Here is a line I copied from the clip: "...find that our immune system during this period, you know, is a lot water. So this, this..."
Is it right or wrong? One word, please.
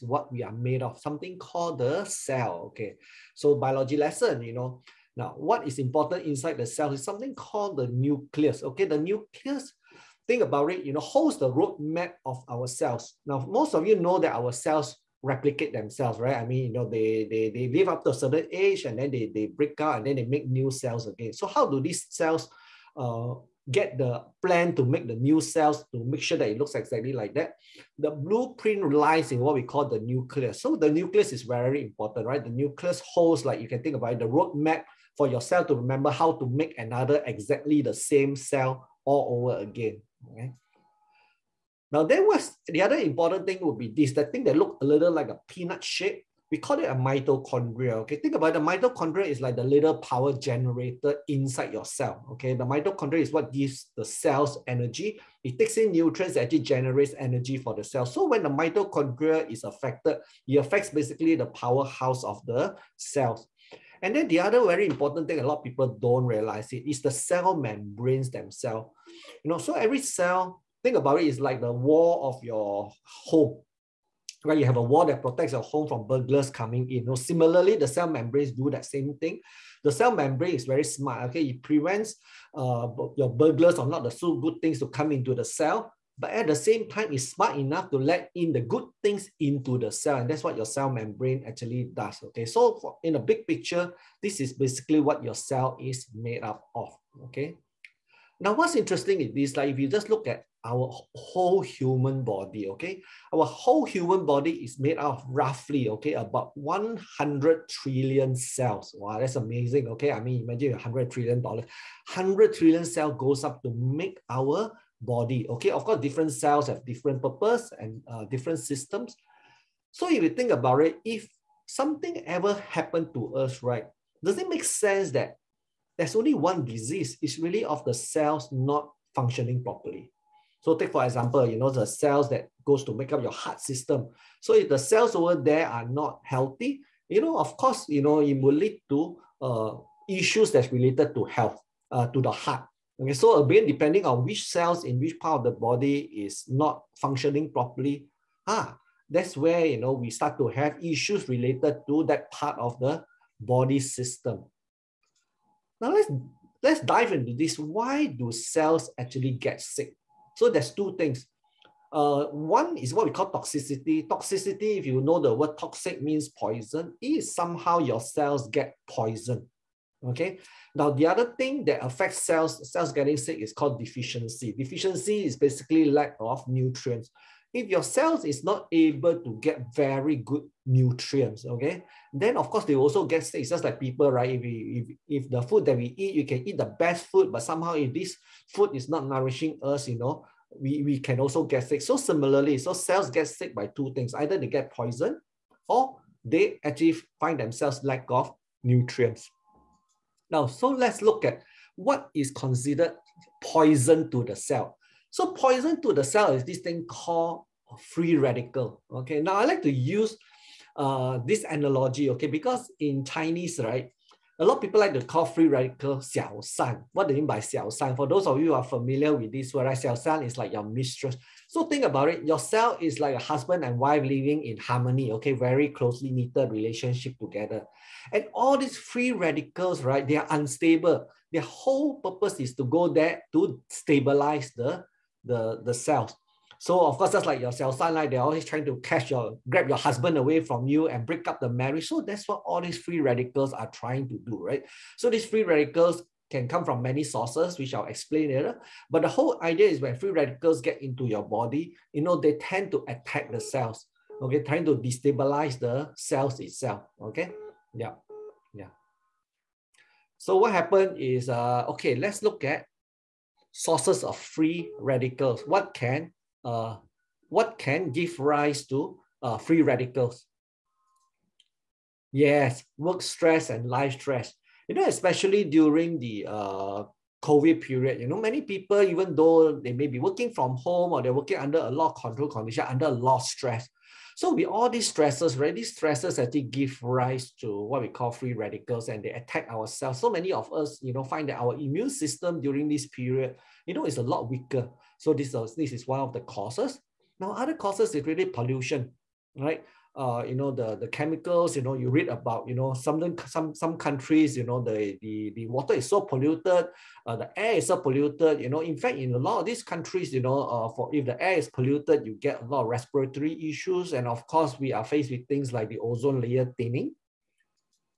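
wrong.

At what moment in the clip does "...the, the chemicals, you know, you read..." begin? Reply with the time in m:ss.
5:00.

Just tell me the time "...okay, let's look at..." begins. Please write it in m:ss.
4:21.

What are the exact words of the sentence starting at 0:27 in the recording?
The blueprint lies in what we call the nucleus.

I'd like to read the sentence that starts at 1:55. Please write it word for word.
Okay, of course, different cells have different purpose and uh, different systems.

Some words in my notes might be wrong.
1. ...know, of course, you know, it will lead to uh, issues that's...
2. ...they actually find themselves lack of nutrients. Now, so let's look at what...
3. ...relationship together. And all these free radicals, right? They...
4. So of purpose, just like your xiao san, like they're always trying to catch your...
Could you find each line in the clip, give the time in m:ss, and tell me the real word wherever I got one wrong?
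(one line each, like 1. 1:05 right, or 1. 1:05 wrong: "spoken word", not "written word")
1. 2:17 right
2. 3:16 right
3. 3:46 right
4. 3:56 wrong: "course", not "purpose".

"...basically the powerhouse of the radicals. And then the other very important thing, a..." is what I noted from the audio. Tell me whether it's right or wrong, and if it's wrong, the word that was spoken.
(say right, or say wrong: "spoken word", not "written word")
wrong: "cells", not "radicals".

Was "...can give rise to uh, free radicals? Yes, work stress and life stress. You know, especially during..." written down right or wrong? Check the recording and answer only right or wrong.
right.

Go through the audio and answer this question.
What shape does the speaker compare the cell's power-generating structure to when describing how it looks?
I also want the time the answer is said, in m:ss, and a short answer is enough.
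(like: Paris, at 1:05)
Peanut, at 0:45.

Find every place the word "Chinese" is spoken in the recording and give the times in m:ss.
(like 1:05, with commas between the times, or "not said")
3:33.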